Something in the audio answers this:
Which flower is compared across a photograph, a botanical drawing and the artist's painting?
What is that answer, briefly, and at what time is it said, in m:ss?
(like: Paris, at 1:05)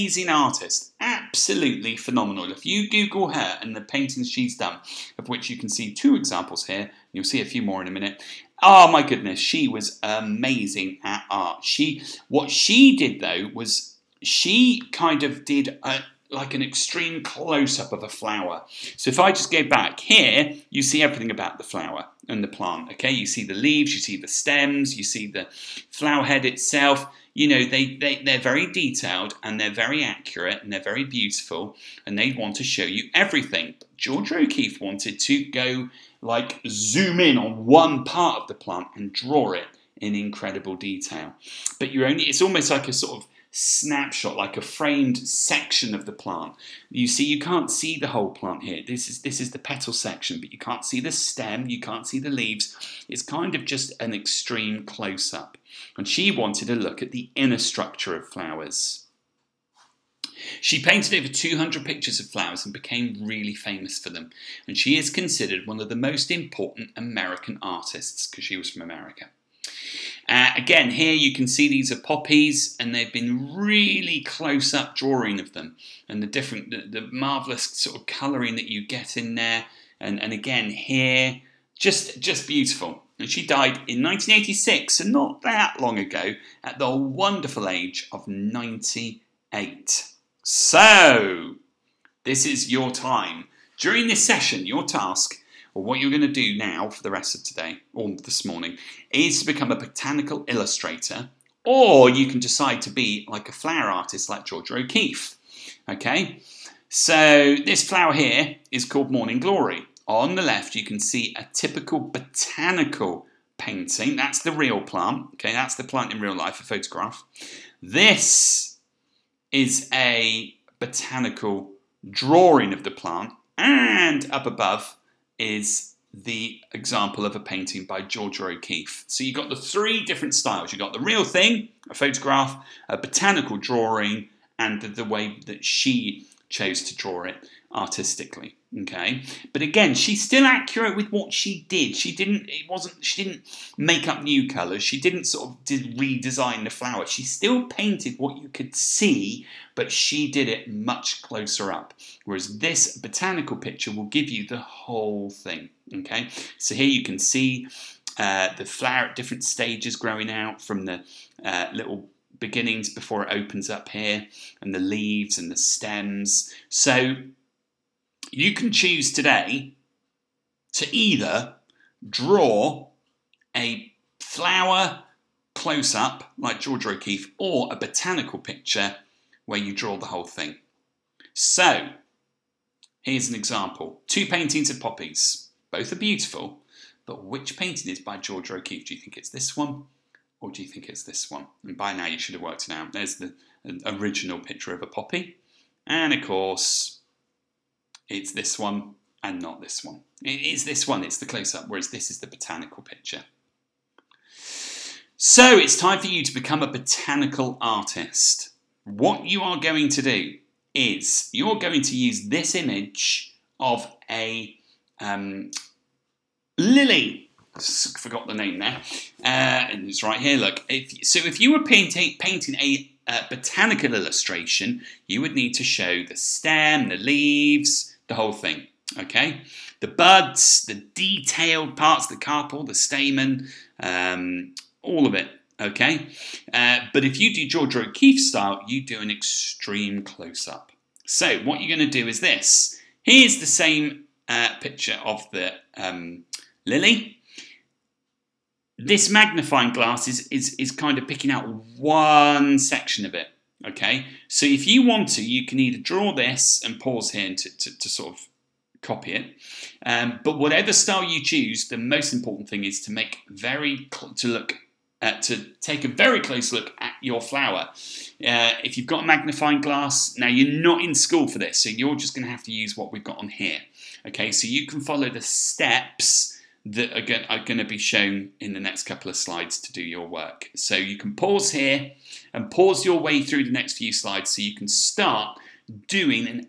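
Morning Glory, at 1:49.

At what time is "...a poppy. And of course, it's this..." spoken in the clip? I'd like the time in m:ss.
3:14.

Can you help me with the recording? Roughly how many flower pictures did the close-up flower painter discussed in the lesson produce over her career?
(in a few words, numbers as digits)
over 200.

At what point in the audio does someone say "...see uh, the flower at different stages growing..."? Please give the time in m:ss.
2:37.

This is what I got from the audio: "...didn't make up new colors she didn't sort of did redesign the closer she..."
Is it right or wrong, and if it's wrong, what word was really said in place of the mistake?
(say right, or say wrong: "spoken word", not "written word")
wrong: "flower", not "closer".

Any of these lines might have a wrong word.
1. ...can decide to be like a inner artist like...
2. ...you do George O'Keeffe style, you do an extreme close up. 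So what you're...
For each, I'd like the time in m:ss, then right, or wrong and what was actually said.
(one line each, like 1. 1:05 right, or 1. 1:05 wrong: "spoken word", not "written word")
1. 1:42 wrong: "flower", not "inner"
2. 3:57 right.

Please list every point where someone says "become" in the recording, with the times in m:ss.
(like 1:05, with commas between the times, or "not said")
1:39, 3:26.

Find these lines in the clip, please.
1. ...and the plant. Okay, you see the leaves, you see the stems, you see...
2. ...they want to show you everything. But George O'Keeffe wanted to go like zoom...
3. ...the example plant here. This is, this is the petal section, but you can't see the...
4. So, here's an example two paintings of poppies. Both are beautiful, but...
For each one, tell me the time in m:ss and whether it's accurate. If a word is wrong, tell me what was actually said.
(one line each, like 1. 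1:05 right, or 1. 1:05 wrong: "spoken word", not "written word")
1. 0:22 right
2. 0:32 right
3. 0:47 wrong: "whole", not "example"
4. 3:01 right.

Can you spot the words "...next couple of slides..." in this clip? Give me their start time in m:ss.
4:38.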